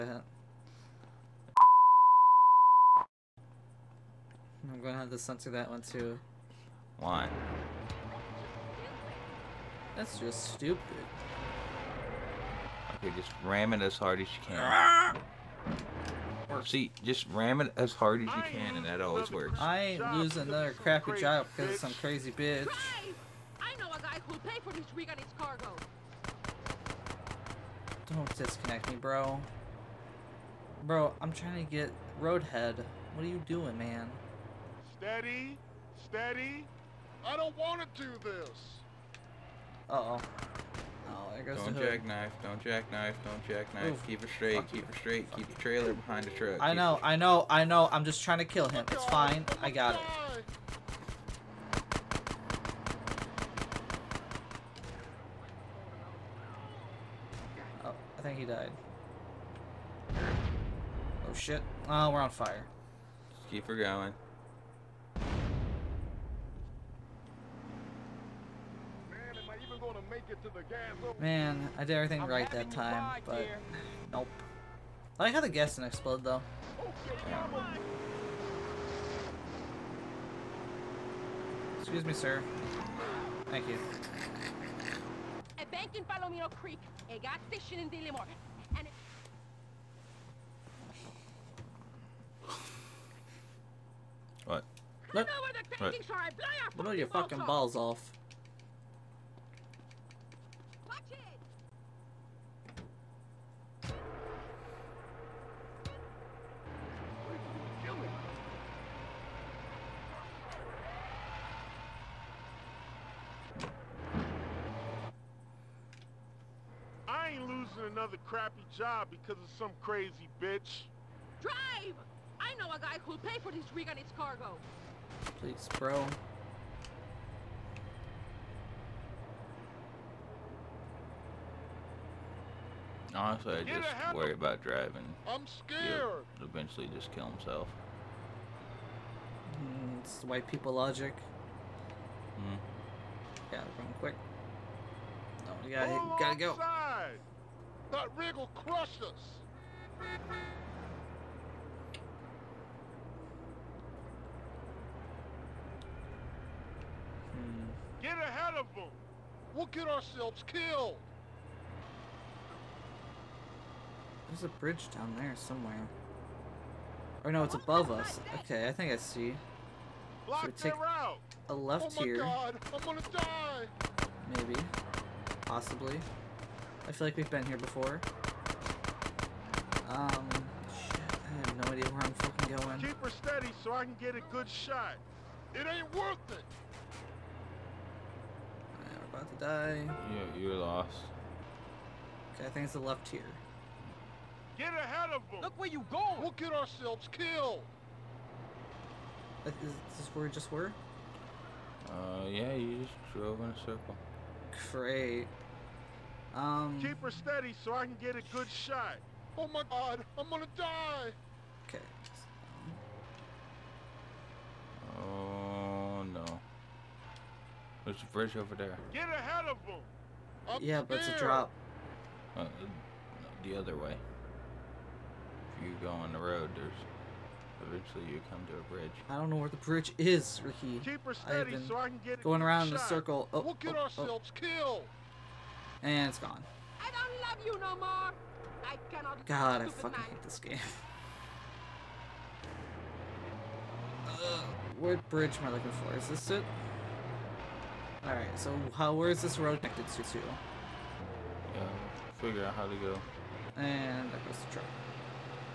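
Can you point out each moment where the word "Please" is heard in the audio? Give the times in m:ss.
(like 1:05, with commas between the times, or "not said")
2:05.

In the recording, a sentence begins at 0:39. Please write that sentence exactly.
Uh oh there goes don't the hood.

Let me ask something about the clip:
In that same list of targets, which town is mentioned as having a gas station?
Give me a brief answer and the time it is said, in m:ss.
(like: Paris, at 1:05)
Dillimore, at 1:27.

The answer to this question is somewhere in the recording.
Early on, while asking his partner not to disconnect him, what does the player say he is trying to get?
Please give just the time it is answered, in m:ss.
0:32.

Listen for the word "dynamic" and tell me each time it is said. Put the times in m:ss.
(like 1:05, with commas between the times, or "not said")
not said.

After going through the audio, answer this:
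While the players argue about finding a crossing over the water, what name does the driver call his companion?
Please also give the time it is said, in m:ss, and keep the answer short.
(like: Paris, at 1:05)
Ricky, at 3:50.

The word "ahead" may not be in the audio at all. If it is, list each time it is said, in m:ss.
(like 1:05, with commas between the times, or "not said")
2:38, 3:14, 3:39.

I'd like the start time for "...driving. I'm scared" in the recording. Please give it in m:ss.
2:14.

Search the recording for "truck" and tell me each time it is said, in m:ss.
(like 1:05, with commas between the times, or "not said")
0:46, 4:14.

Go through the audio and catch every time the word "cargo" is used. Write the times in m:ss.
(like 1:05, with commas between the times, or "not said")
0:25, 2:04.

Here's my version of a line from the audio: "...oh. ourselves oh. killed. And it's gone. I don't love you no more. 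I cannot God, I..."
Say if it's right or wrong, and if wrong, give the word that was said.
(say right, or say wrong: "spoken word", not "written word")
right.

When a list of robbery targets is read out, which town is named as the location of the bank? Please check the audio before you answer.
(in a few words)
Palomino Creek.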